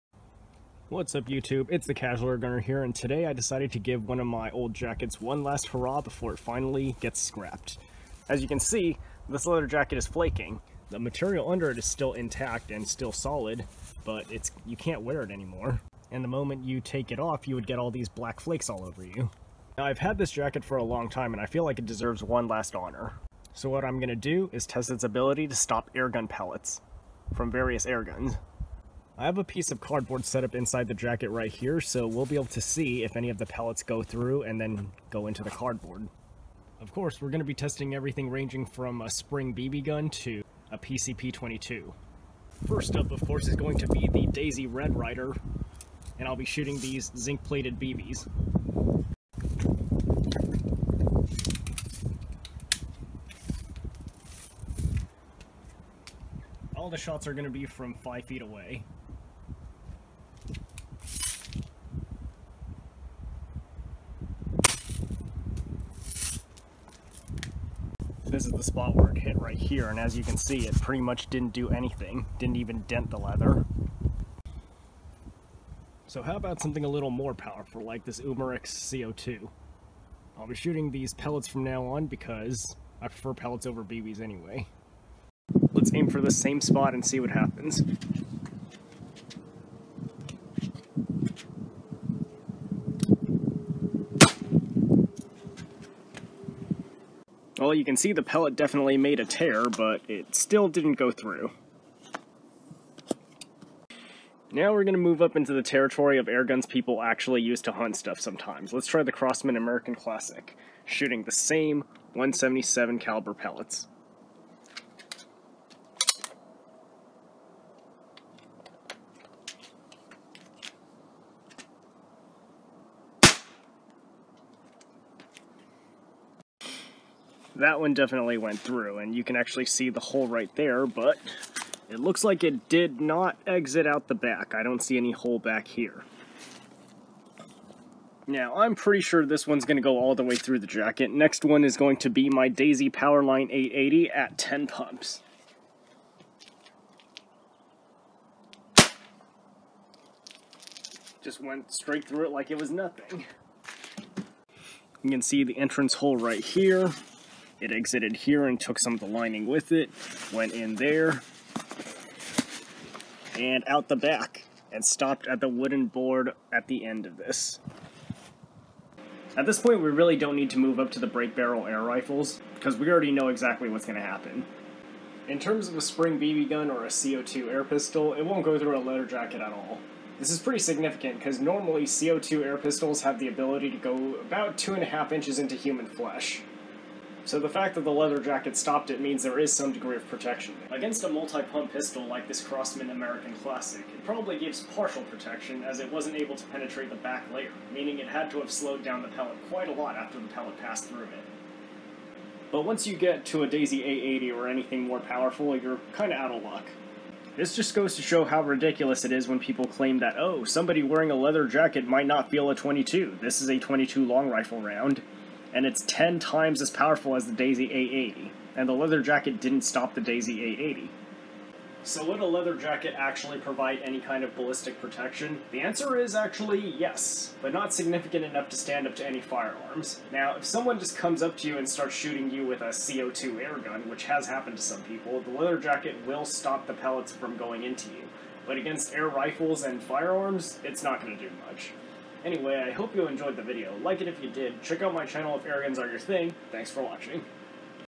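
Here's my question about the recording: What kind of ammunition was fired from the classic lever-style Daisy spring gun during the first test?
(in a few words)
zinc-plated BBs.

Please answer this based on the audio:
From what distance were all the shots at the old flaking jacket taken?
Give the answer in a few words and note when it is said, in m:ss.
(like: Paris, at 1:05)
5 feet, at 0:57.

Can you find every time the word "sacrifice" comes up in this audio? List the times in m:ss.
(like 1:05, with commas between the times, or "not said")
not said.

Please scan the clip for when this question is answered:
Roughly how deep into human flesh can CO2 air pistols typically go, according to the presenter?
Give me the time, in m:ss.
3:04.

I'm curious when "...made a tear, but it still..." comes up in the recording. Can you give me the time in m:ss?
1:38.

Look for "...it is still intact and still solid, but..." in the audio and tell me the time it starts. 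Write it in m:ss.
0:11.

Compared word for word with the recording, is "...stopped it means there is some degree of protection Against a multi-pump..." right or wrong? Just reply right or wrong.
right.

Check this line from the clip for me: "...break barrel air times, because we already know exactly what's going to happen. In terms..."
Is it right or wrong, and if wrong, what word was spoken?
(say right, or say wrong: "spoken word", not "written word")
wrong: "rifles", not "times".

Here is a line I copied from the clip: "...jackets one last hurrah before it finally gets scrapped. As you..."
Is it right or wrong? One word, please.
right.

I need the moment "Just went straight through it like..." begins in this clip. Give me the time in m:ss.
2:31.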